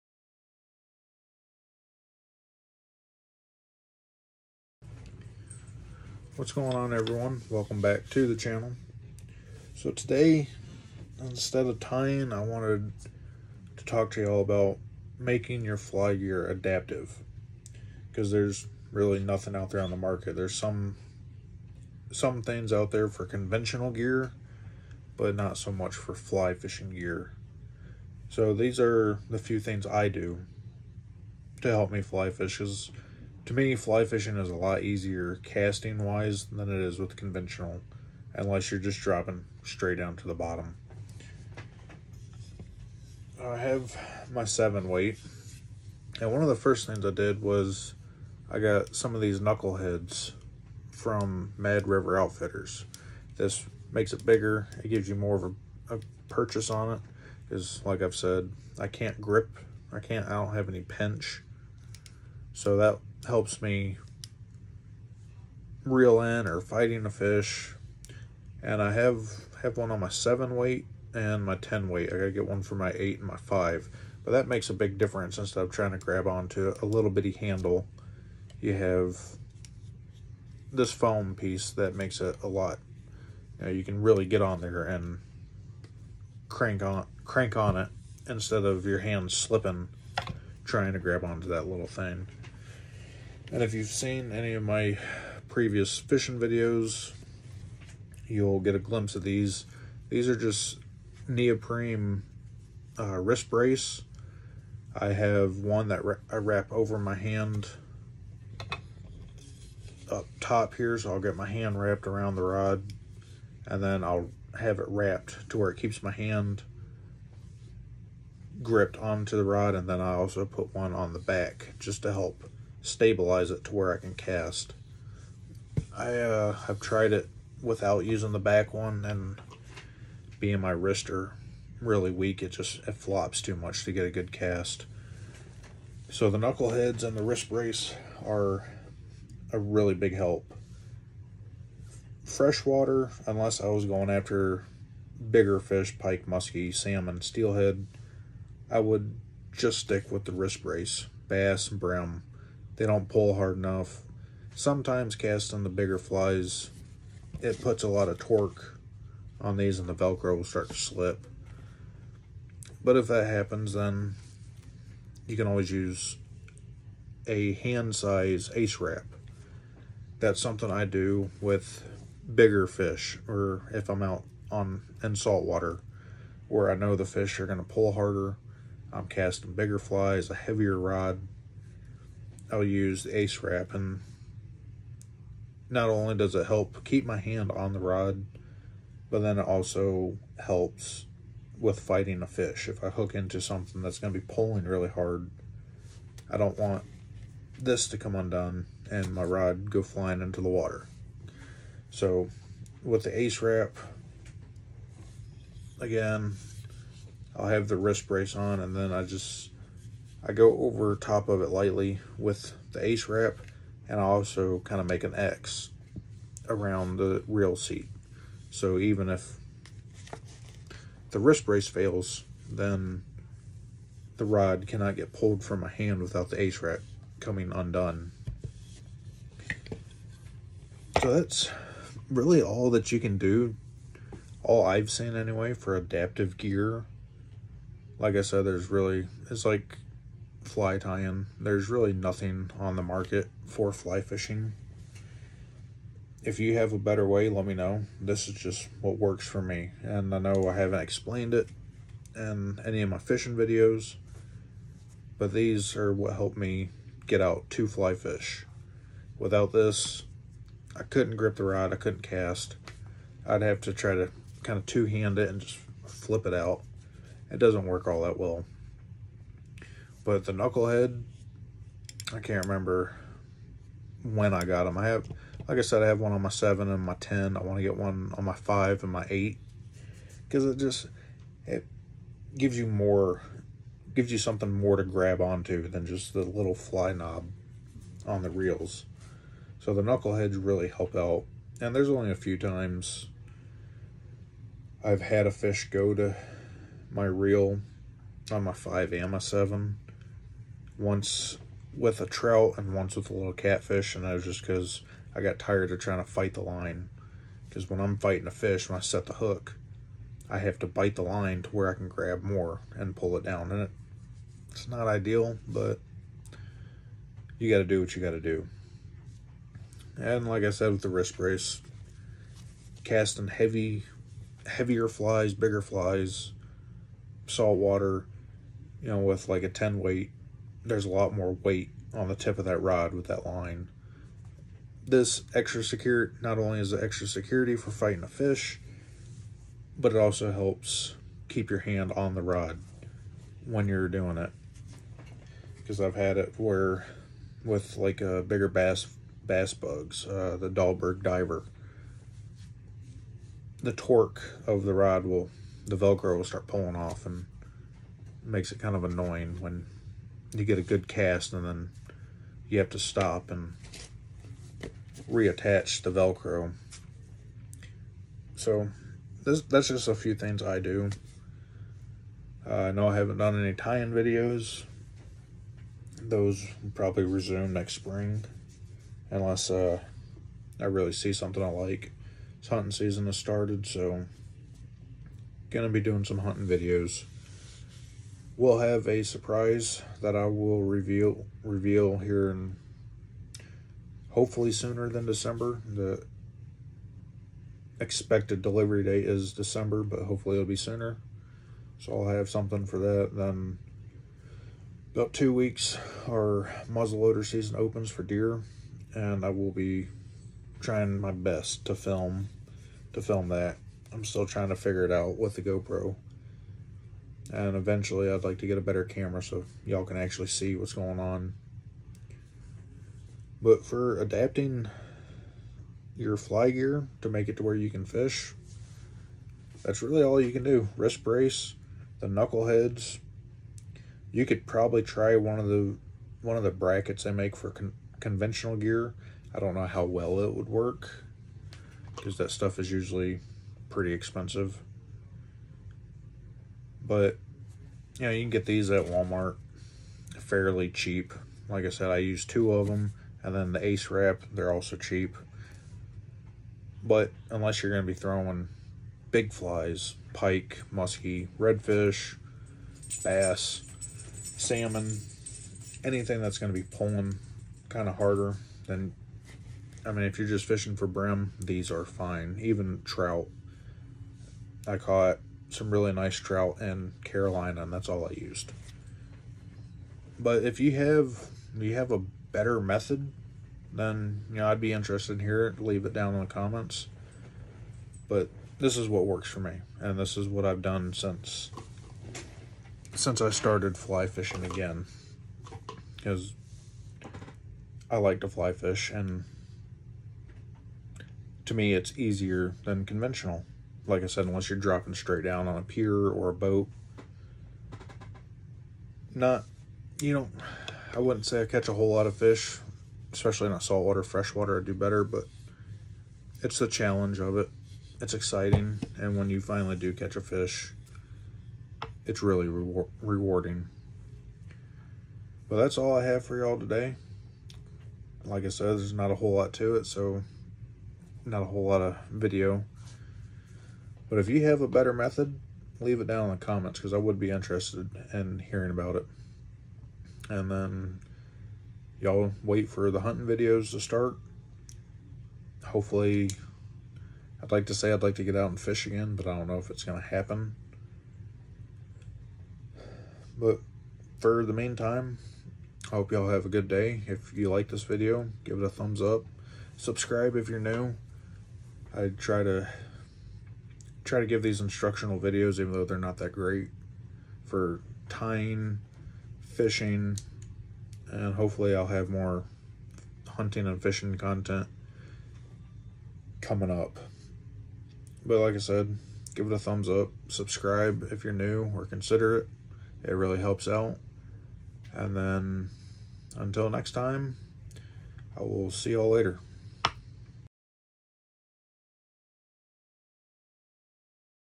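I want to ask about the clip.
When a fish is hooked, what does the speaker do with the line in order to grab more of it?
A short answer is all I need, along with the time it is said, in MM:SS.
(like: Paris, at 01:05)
bite the line, at 05:10.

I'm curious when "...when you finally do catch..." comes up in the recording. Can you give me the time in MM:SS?
08:39.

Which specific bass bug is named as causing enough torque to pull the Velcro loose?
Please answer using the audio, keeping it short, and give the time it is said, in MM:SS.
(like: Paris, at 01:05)
Dahlberg diver, at 05:50.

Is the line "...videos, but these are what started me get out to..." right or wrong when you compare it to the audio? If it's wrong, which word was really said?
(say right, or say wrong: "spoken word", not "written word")
wrong: "helped", not "started".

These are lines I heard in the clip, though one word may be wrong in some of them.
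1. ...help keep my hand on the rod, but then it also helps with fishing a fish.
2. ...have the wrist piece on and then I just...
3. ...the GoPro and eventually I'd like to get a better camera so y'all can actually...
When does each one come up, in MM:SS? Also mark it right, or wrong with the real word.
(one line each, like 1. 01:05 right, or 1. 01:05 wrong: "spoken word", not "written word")
1. 03:06 wrong: "fighting", not "fishing"
2. 03:27 wrong: "brace", not "piece"
3. 06:55 right.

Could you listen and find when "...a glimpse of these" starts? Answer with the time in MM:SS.
01:38.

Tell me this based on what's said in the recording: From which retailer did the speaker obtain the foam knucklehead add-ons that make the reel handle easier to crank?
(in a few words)
Mad River Outfitters.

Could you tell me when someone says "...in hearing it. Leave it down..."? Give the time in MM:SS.
08:05.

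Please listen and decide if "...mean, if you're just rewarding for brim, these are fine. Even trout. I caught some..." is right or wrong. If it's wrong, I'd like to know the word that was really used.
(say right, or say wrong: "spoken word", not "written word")
wrong: "fishing", not "rewarding".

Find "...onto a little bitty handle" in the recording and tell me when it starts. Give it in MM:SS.
01:16.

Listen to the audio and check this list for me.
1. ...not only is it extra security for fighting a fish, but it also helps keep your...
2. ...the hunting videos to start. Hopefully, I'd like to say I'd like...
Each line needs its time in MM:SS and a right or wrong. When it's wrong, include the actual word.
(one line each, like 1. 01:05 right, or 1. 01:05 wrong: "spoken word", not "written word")
1. 05:36 right
2. 09:02 right.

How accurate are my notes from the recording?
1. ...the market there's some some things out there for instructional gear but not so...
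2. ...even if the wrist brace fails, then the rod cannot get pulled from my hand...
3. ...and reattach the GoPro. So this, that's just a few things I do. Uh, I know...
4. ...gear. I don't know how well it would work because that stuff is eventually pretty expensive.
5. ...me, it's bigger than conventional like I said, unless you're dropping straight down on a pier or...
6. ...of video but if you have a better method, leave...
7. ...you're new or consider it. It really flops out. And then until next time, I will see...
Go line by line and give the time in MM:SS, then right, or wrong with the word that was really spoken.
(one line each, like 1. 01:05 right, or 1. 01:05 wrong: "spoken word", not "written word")
1. 00:19 wrong: "conventional", not "instructional"
2. 03:38 right
3. 06:03 wrong: "Velcro", not "GoPro"
4. 07:18 wrong: "usually", not "eventually"
5. 08:21 wrong: "easier", not "bigger"
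6. 08:51 right
7. 09:41 wrong: "helps", not "flops".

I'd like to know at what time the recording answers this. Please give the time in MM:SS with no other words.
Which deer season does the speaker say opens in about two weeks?
06:46.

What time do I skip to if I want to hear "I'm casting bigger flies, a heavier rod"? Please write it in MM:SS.
02:58.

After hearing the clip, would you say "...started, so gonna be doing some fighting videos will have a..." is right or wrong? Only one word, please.
wrong.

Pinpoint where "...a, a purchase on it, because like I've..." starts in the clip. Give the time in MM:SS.
00:55.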